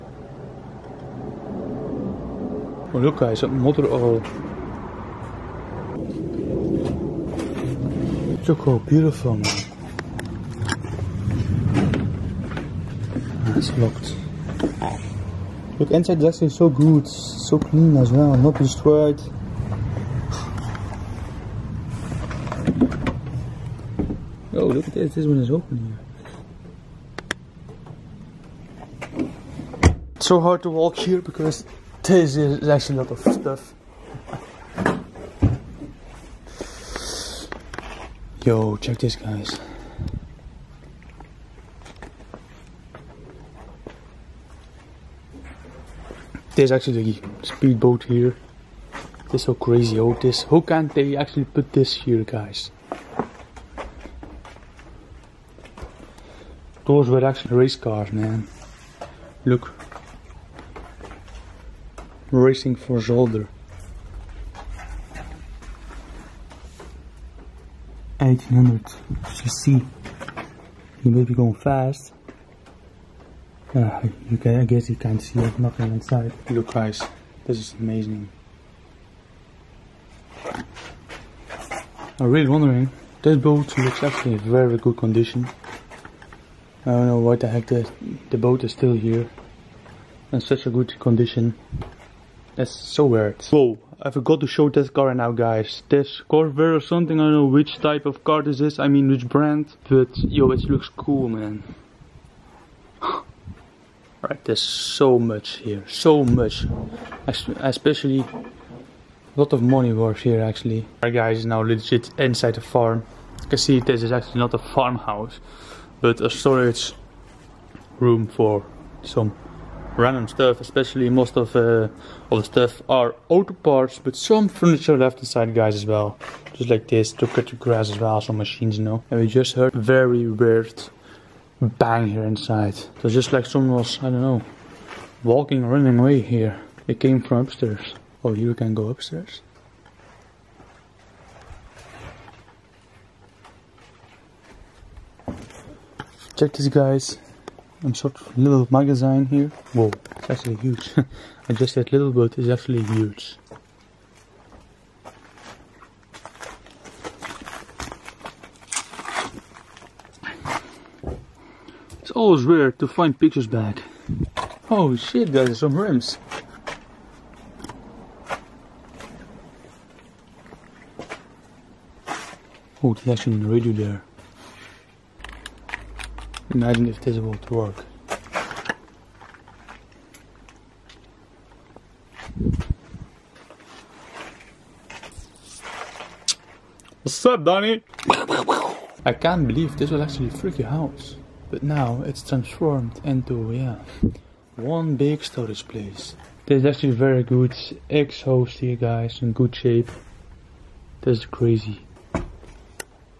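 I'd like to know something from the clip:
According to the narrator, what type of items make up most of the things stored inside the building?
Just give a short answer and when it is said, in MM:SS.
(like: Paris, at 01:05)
auto parts, at 02:03.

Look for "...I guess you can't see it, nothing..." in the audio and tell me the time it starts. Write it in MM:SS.
01:14.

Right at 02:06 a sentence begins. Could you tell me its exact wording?
Just like this, to cut the grass as well, some machines you know.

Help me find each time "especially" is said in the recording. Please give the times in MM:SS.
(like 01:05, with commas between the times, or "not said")
01:47, 02:00.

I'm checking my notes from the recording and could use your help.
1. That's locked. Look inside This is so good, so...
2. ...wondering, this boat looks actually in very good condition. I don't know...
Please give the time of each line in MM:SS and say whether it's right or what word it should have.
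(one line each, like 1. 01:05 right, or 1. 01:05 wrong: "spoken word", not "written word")
1. 00:13 right
2. 01:22 right.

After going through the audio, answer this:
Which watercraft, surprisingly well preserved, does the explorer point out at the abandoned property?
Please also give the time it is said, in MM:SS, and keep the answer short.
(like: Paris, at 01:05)
speedboat, at 00:47.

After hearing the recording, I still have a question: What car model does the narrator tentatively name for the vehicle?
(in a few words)
Corvair.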